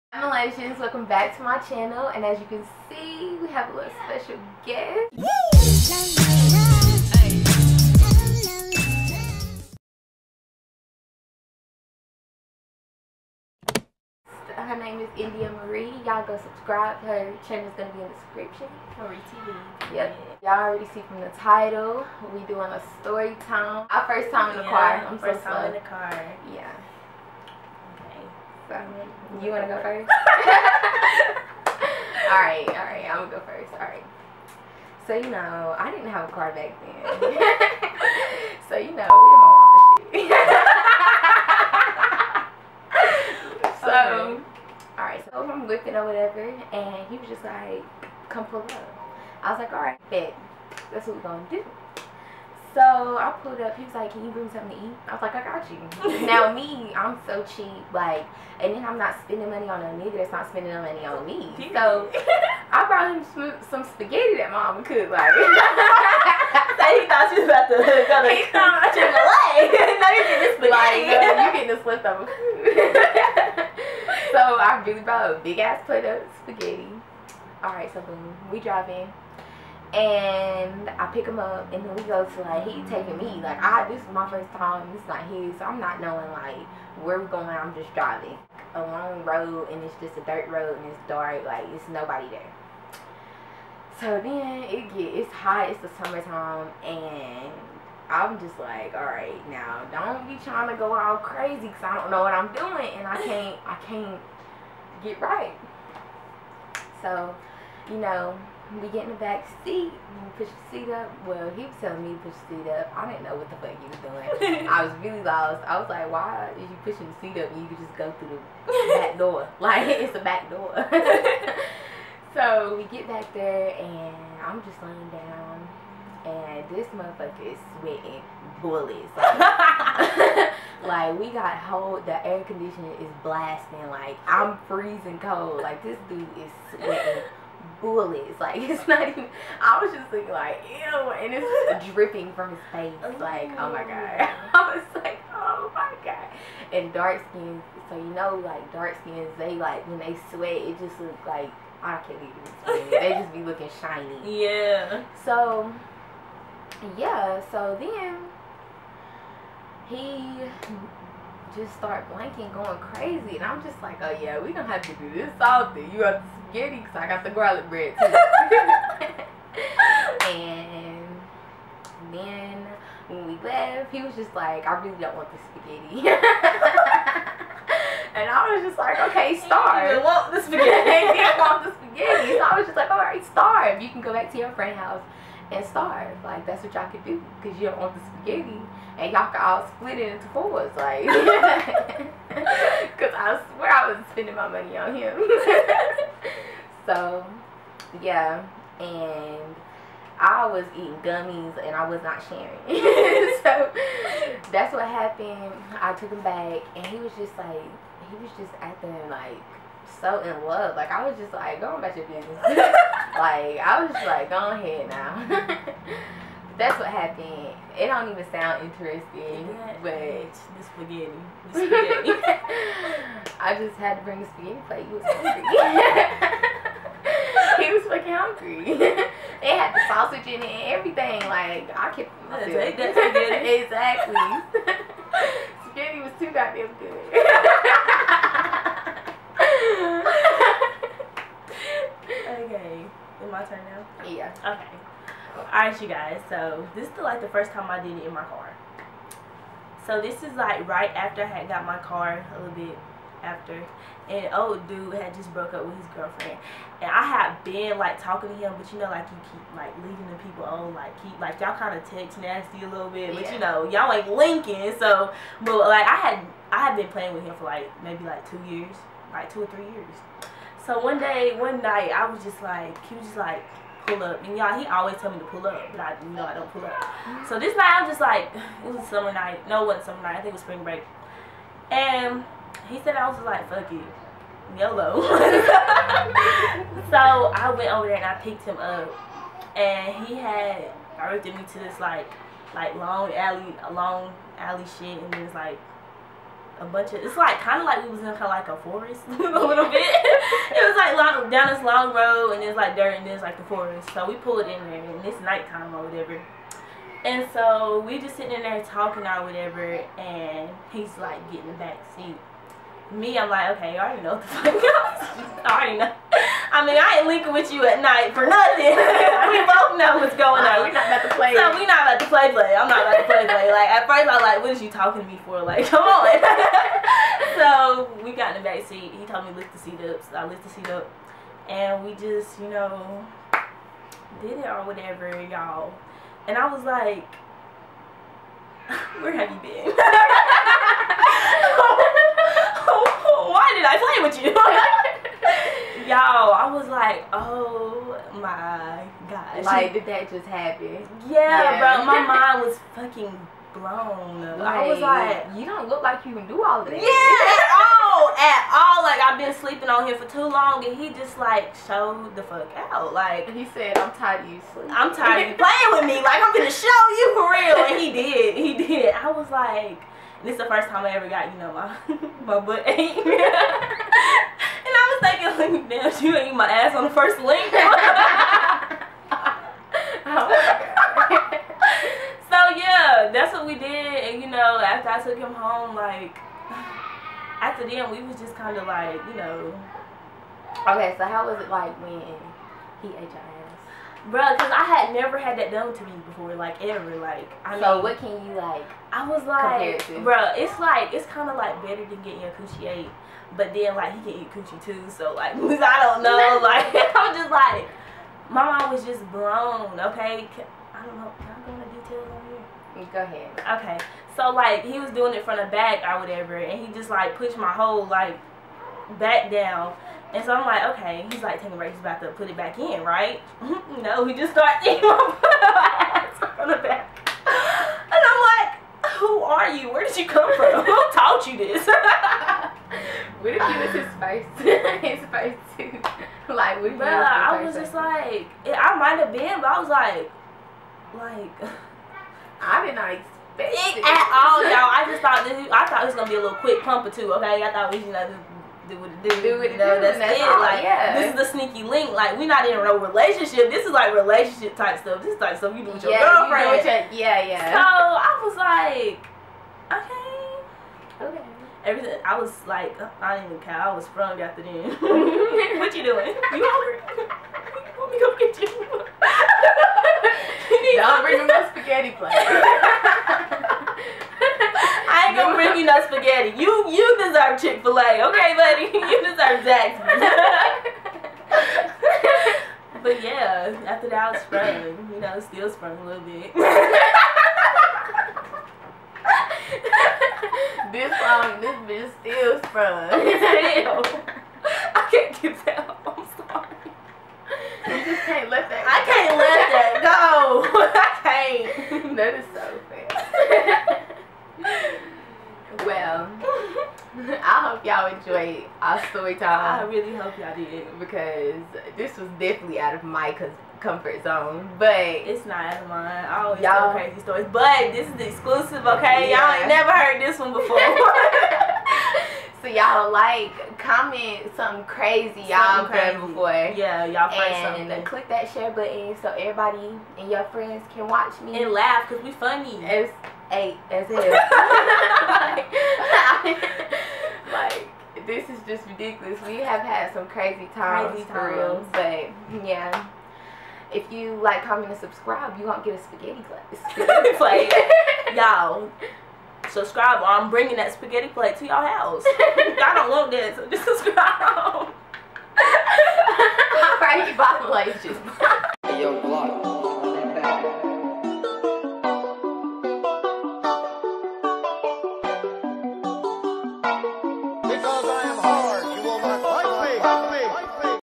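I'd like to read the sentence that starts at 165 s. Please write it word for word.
You got the spaghetti because I got the garlic bread too.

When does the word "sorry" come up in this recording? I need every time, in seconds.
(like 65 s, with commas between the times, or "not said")
496 s.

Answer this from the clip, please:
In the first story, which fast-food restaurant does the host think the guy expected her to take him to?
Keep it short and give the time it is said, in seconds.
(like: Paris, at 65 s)
Chick-fil-A, at 67 s.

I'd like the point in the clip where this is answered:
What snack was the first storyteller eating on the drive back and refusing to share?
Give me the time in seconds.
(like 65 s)
201 s.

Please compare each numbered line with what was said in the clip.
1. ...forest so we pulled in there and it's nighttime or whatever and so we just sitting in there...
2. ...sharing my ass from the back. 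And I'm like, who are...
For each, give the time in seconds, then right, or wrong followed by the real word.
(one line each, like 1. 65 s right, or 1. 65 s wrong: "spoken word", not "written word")
1. 303 s right
2. 424 s wrong: "eating", not "sharing".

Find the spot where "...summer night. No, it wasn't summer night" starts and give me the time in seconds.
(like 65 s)
278 s.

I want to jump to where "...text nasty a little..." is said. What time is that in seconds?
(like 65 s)
261 s.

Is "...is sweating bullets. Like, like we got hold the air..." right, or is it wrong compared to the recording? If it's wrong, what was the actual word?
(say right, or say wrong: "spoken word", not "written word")
right.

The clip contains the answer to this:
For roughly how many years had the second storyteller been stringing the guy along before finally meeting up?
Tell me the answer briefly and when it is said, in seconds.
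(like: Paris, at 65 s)
2, at 268 s.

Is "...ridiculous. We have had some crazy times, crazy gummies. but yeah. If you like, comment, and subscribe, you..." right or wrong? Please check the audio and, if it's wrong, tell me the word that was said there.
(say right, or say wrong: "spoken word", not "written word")
wrong: "times", not "gummies".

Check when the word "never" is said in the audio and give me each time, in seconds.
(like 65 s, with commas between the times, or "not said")
394 s, 519 s.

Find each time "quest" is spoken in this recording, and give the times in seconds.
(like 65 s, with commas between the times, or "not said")
not said.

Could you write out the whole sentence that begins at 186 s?
Like that's what y'all could do because you don't want the spaghetti and y'all could all split it into fours.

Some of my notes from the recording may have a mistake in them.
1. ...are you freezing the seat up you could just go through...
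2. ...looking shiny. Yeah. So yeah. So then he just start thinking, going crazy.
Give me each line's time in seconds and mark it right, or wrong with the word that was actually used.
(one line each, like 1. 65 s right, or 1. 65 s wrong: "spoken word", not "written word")
1. 116 s wrong: "pushing", not "freezing"
2. 153 s wrong: "blanking", not "thinking".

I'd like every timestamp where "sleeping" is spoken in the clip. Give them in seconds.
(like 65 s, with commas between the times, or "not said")
359 s, 364 s.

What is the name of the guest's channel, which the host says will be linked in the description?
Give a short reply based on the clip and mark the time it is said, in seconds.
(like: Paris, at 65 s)
Maree TV, at 18 s.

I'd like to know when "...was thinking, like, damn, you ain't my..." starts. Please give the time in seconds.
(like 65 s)
375 s.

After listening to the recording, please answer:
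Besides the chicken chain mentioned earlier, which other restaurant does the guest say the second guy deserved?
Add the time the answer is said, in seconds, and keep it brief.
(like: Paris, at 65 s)
Zaxby's, at 479 s.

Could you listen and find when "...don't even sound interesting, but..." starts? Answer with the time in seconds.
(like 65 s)
217 s.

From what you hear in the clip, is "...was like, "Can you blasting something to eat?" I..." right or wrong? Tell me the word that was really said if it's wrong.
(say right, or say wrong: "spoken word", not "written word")
wrong: "bring", not "blasting".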